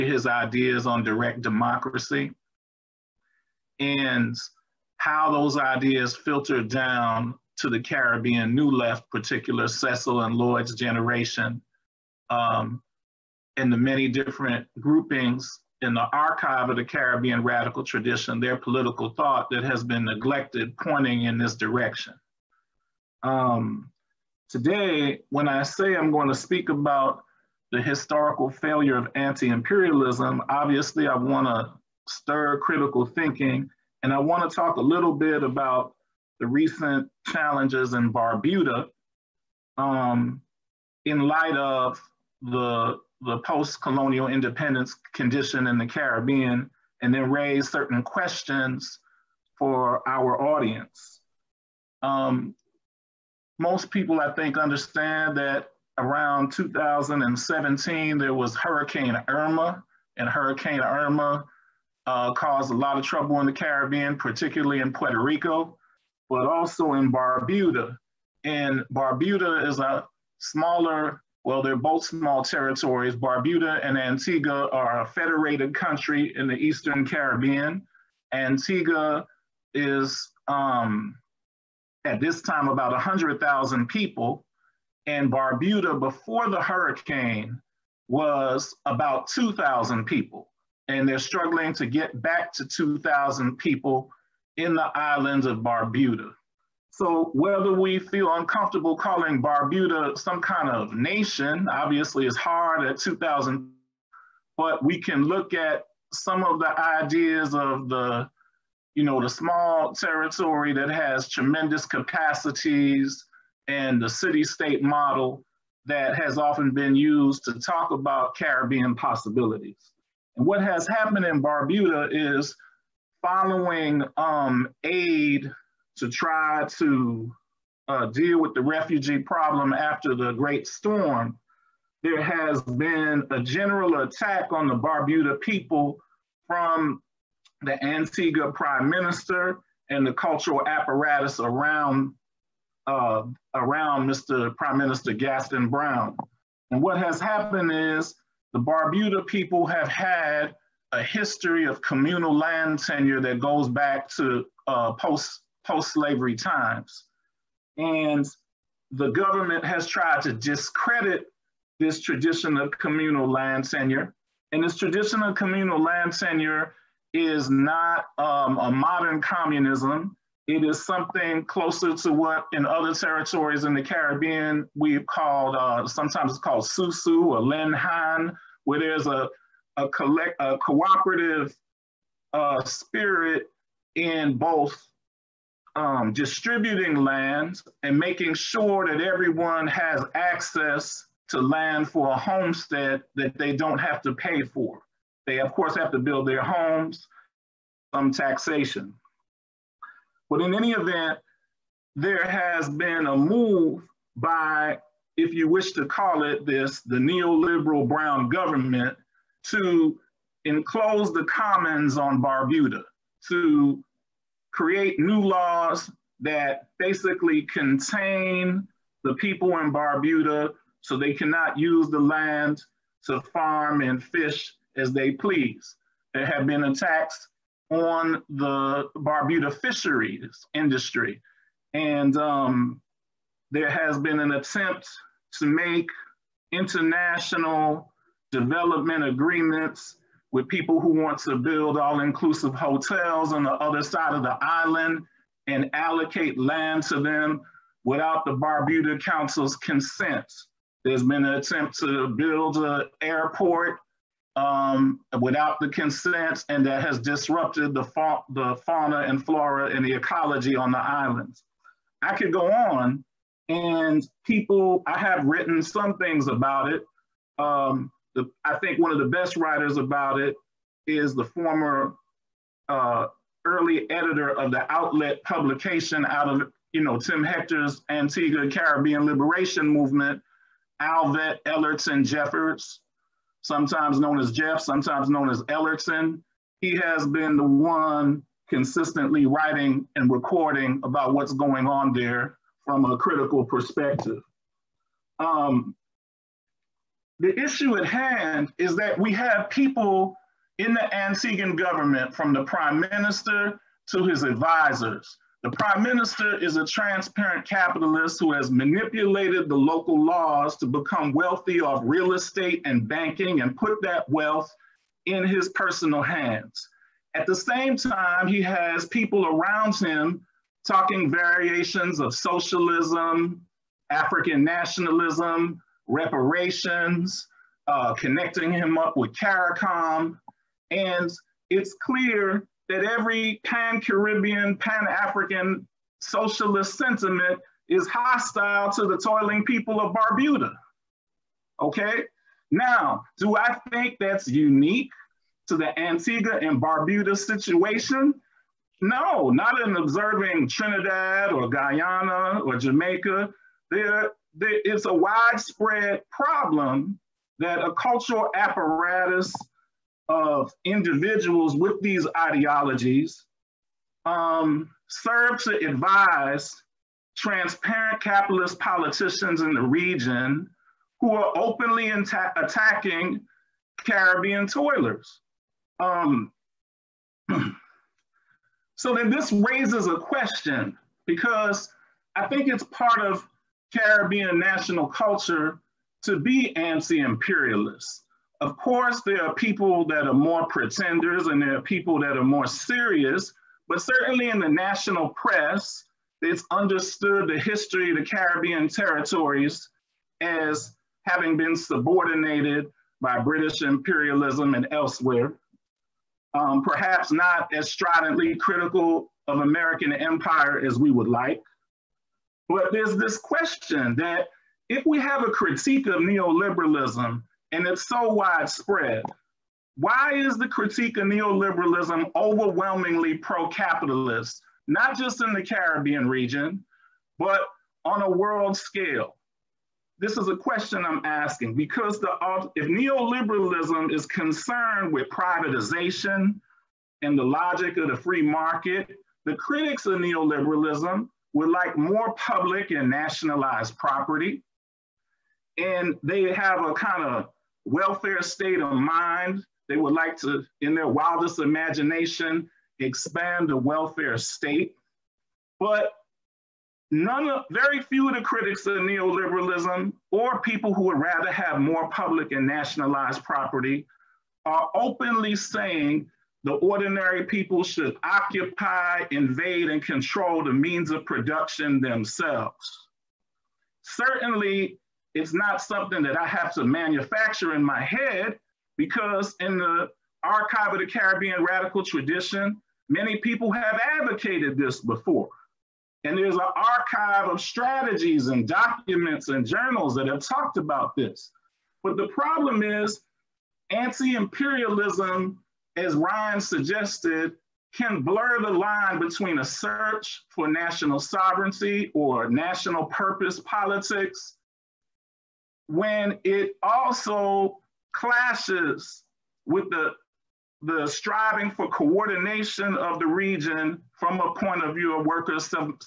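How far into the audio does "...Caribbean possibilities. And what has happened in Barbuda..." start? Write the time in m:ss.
1:58.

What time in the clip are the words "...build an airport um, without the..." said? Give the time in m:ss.
4:12.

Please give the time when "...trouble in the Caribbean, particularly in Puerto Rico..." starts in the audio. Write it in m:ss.
1:03.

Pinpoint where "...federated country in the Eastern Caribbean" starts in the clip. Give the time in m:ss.
1:15.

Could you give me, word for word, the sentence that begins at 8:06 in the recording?
And there's an archive of strategies and documents and journals that have talked about this.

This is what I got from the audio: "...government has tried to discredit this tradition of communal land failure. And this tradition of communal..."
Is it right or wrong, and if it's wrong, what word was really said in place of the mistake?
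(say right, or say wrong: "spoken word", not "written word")
wrong: "tenure", not "failure".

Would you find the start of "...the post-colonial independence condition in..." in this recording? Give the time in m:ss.
0:43.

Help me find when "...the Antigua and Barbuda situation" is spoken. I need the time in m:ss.
5:45.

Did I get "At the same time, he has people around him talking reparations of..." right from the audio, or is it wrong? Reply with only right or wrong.
wrong.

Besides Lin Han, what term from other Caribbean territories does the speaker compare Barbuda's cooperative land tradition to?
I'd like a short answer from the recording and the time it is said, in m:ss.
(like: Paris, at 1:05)
Susu, at 2:56.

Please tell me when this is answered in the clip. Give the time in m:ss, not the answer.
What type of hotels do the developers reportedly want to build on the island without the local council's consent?
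4:01.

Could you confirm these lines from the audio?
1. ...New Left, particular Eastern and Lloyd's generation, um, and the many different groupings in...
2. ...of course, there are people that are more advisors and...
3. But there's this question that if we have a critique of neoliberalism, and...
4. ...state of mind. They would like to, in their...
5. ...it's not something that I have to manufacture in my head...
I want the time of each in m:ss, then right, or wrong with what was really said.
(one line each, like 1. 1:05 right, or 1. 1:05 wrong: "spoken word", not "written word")
1. 0:08 wrong: "Cecil", not "Eastern"
2. 6:28 wrong: "pretenders", not "advisors"
3. 6:52 right
4. 7:28 right
5. 7:55 right.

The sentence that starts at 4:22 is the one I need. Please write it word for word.
I could go on and people, I have written some things about it.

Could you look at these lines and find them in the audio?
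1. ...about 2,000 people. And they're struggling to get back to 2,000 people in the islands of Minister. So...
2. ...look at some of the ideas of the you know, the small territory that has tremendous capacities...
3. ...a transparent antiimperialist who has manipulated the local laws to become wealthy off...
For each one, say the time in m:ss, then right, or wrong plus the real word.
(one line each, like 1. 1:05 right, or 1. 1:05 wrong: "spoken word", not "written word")
1. 1:28 wrong: "Barbuda", not "Minister"
2. 1:45 right
3. 5:06 wrong: "capitalist", not "antiimperialist".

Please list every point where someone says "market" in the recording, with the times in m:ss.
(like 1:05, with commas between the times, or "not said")
7:18.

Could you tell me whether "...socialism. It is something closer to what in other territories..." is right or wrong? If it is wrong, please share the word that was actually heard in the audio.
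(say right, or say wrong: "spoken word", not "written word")
wrong: "communism", not "socialism".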